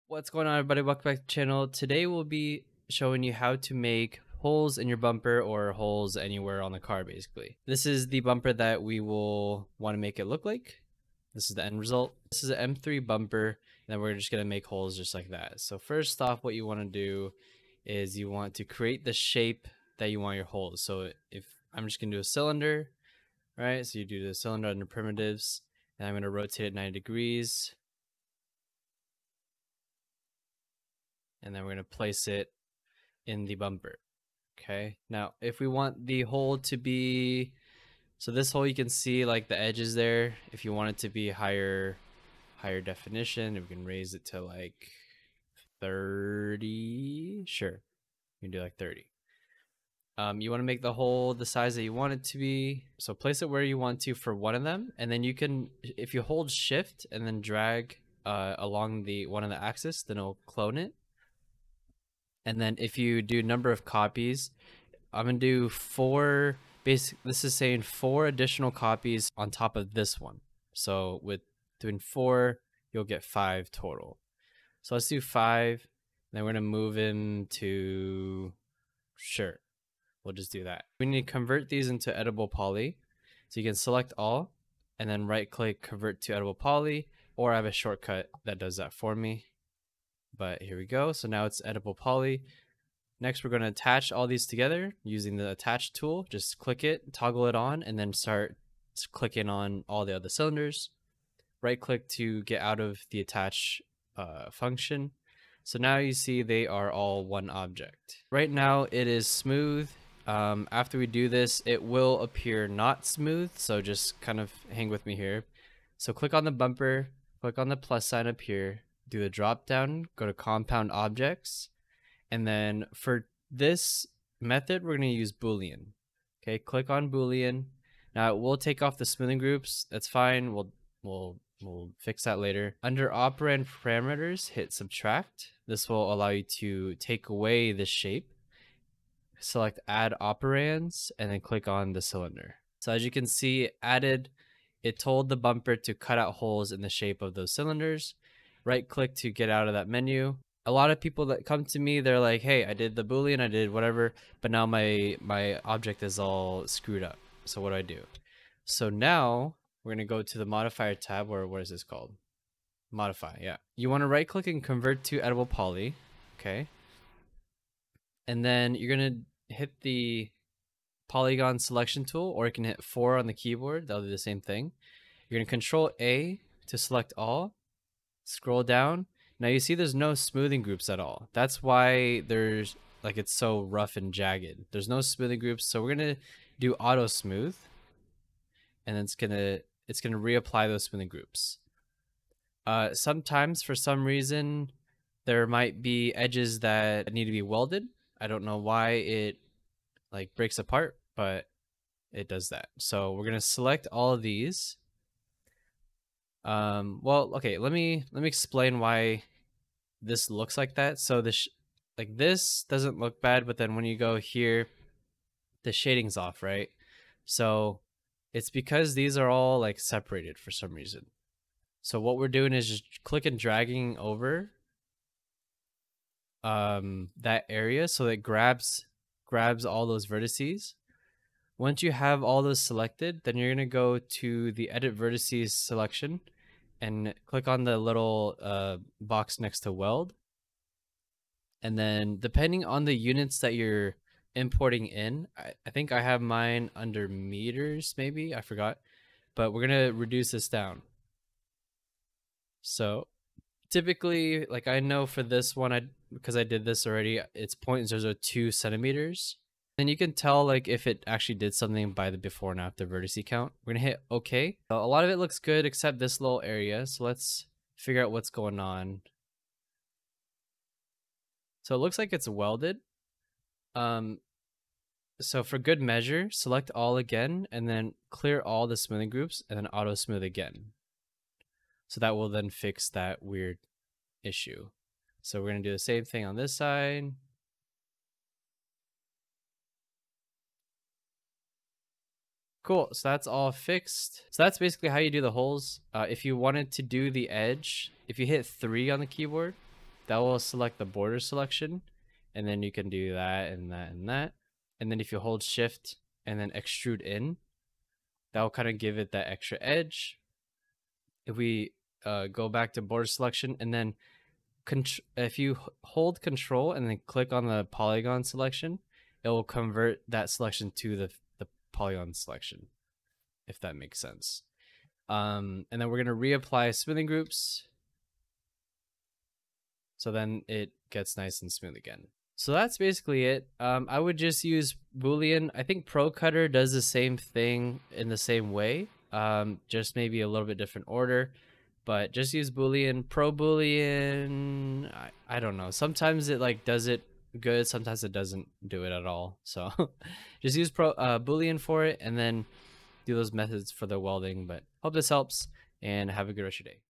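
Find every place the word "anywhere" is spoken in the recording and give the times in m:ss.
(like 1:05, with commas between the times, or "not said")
0:06.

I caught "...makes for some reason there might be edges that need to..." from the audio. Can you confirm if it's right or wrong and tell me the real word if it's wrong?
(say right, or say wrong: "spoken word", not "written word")
wrong: "sometimes", not "makes".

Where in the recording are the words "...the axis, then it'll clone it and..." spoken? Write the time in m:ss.
0:59.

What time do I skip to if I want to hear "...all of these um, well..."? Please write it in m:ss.
3:23.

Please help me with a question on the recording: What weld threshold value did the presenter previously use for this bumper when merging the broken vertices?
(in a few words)
0.002 centimeters.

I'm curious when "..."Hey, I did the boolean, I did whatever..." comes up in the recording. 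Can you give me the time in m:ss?
2:32.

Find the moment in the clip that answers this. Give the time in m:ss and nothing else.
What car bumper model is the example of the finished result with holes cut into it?
0:12.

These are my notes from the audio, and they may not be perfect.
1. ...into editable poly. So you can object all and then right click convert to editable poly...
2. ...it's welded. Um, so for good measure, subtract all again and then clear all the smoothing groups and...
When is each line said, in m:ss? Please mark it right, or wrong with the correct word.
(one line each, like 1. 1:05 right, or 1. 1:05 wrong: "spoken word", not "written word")
1. 1:21 wrong: "select", not "object"
2. 4:32 wrong: "select", not "subtract".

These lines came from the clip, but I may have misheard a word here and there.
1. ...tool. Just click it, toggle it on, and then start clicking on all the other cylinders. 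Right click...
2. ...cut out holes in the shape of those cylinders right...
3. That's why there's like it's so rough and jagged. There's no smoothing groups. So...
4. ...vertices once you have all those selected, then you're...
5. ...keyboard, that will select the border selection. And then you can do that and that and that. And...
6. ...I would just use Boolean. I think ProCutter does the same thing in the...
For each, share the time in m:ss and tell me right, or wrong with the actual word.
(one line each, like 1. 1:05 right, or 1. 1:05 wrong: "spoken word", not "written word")
1. 1:35 right
2. 2:25 right
3. 3:01 right
4. 3:50 right
5. 4:59 right
6. 5:33 right.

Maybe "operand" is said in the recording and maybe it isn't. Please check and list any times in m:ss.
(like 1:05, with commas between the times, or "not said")
2:13, 2:20.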